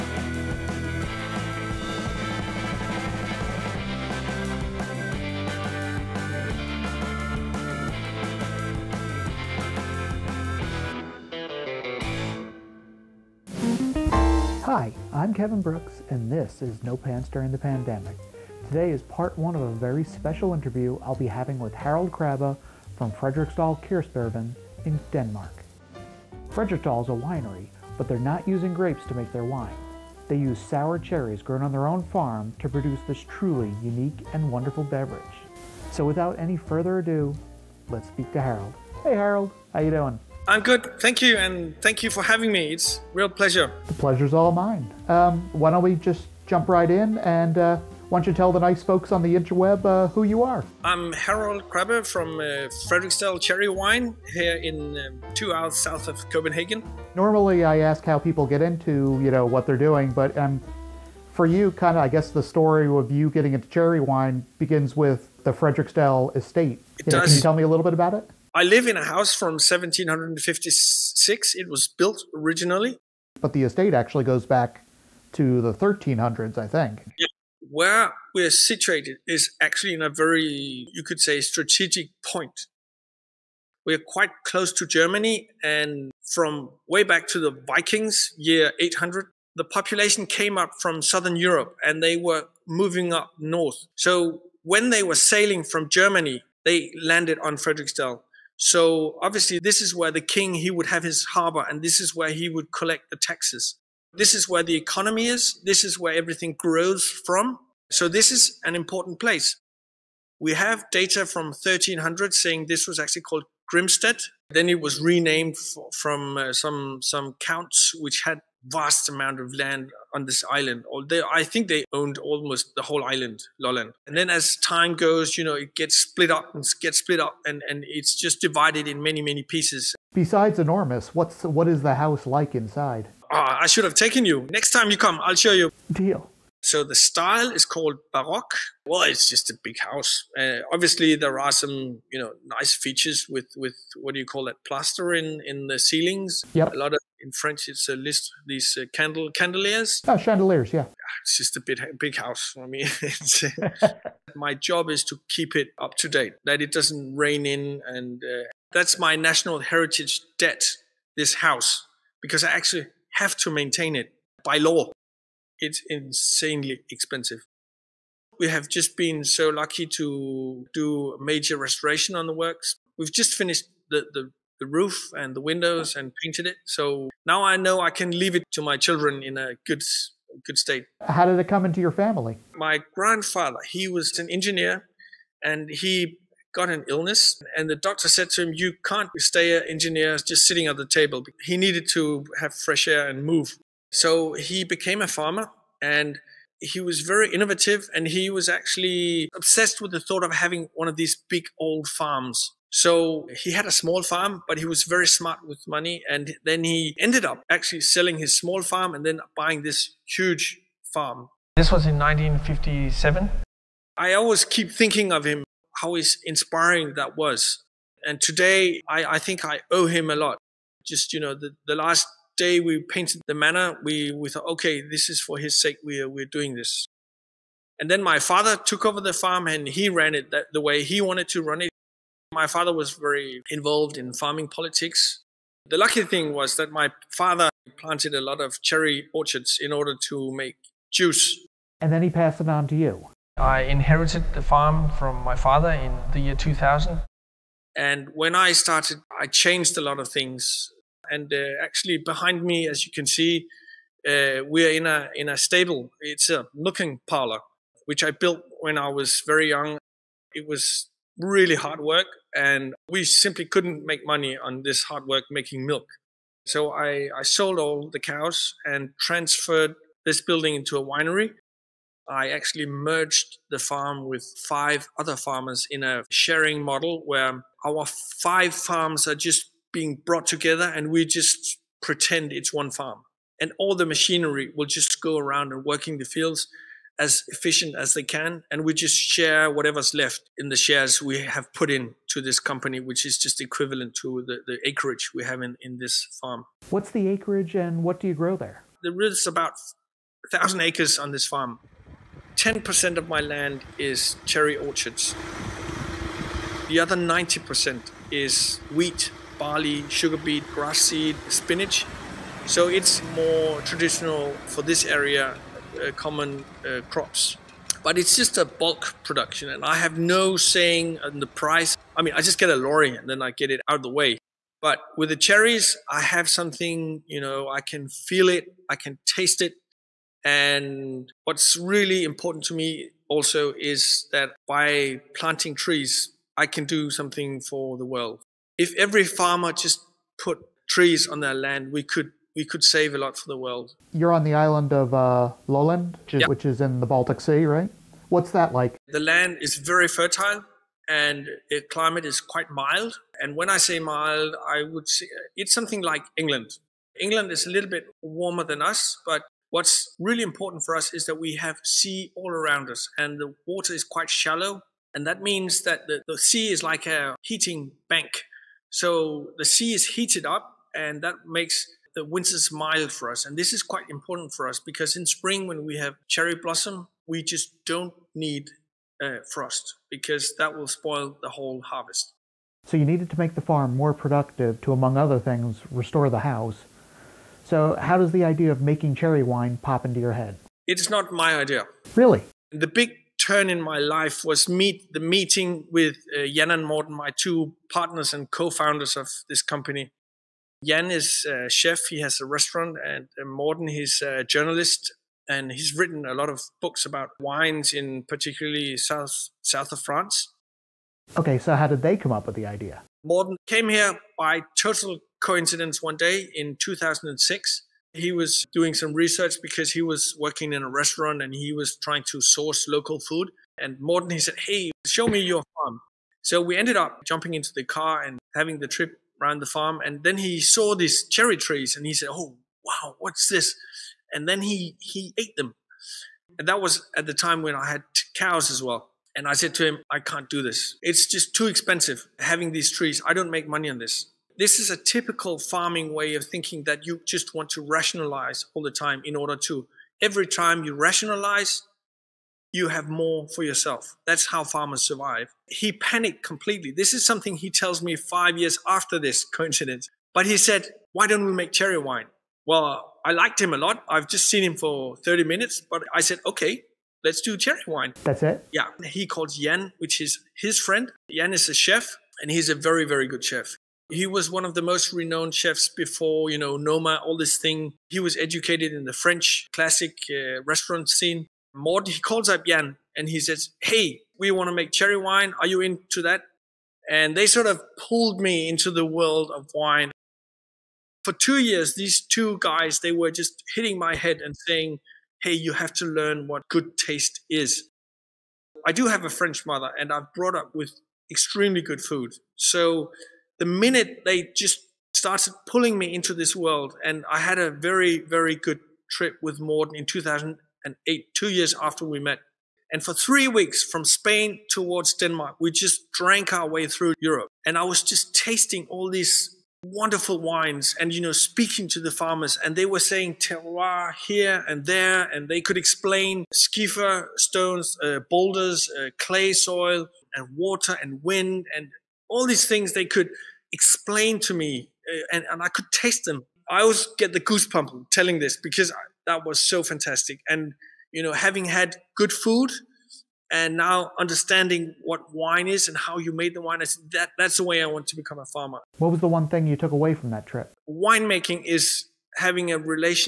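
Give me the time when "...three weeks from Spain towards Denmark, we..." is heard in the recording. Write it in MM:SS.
08:32.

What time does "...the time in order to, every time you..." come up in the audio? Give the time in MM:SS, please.
07:28.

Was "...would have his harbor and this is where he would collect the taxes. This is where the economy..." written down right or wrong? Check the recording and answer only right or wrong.
right.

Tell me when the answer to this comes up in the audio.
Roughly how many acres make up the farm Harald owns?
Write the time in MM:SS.
05:00.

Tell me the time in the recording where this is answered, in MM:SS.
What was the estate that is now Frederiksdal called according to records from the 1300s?
01:53.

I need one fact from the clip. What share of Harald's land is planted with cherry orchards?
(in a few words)
10%.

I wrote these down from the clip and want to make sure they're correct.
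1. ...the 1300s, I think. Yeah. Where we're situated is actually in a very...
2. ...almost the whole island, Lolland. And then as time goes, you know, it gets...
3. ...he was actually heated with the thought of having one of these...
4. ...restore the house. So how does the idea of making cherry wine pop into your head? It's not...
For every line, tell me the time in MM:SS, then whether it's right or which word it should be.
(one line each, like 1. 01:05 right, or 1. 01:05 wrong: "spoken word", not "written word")
1. 01:15 right
2. 02:02 right
3. 03:18 wrong: "obsessed", not "heated"
4. 06:25 right.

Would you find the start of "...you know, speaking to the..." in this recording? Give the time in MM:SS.
08:40.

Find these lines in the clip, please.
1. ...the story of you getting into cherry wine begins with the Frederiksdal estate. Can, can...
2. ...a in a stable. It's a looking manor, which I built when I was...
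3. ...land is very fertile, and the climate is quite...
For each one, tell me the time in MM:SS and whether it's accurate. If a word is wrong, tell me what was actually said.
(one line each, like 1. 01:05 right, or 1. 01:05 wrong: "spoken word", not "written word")
1. 01:02 right
2. 04:14 wrong: "parlor", not "manor"
3. 05:49 right.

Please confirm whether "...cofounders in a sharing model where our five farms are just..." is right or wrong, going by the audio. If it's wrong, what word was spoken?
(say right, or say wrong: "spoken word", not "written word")
wrong: "farmers", not "cofounders".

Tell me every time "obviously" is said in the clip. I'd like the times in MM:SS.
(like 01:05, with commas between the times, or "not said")
01:39, 02:20.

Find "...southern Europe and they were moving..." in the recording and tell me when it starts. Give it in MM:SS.
01:31.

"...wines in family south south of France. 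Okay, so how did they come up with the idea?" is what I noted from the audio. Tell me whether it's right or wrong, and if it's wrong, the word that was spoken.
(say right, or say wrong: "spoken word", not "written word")
wrong: "particularly", not "family".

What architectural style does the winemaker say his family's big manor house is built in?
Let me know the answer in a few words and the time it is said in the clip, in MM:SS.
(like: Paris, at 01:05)
Baroque, at 02:18.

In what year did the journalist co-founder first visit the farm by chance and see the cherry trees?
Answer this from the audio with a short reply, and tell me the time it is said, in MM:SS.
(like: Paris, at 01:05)
2006, at 06:56.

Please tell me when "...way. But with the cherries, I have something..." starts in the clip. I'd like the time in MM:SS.
05:23.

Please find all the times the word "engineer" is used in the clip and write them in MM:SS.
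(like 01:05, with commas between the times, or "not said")
03:04, 03:09.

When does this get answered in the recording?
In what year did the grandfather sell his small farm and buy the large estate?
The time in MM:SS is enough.
03:31.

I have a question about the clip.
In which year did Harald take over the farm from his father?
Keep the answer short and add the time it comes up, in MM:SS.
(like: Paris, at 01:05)
2000, at 04:06.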